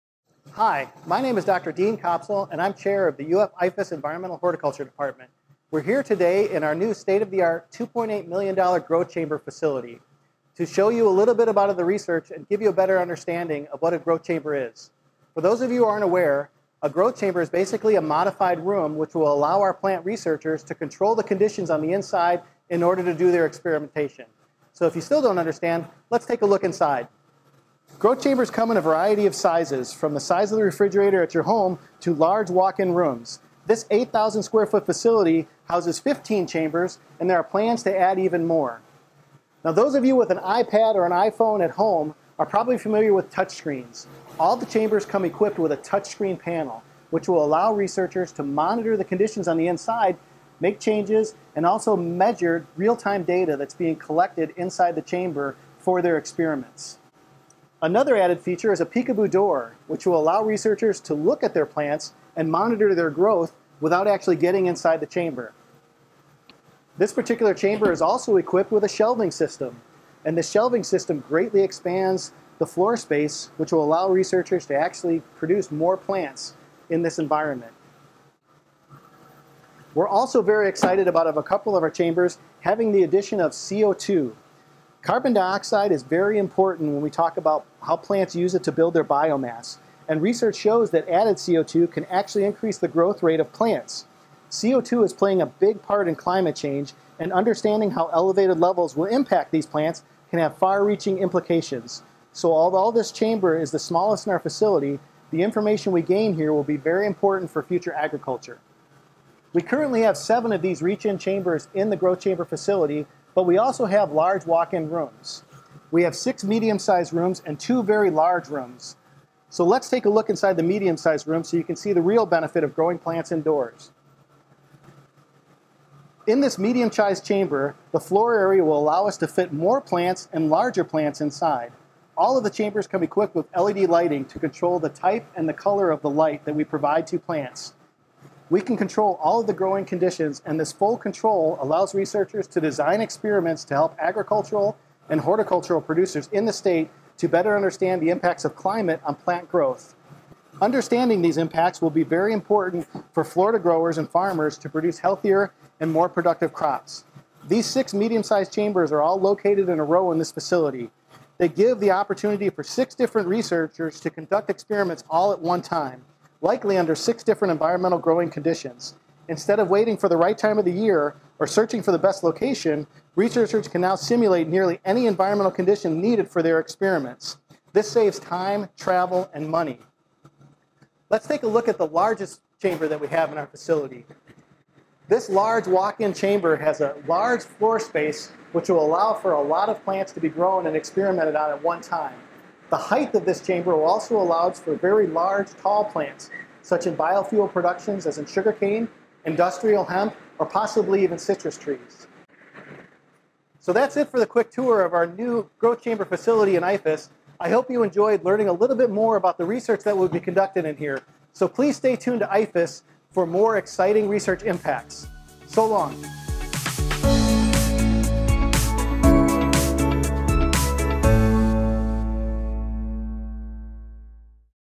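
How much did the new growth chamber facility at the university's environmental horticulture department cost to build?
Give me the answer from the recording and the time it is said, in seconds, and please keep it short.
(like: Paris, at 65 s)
$2.8 million, at 7 s.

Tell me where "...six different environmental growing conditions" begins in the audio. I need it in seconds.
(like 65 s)
166 s.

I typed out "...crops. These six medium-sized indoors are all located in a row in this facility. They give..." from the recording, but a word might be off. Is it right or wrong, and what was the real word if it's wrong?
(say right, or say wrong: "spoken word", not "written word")
wrong: "chambers", not "indoors".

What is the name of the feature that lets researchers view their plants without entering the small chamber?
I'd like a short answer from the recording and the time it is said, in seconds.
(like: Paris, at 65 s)
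peekaboo door, at 58 s.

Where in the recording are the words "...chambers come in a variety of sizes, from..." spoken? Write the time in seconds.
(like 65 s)
28 s.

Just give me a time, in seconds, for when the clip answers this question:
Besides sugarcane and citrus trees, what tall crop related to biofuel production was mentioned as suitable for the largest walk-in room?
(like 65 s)
199 s.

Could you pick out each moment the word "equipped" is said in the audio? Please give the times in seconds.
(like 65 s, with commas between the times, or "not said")
45 s, 68 s, 133 s.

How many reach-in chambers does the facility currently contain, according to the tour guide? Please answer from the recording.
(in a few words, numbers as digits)
7.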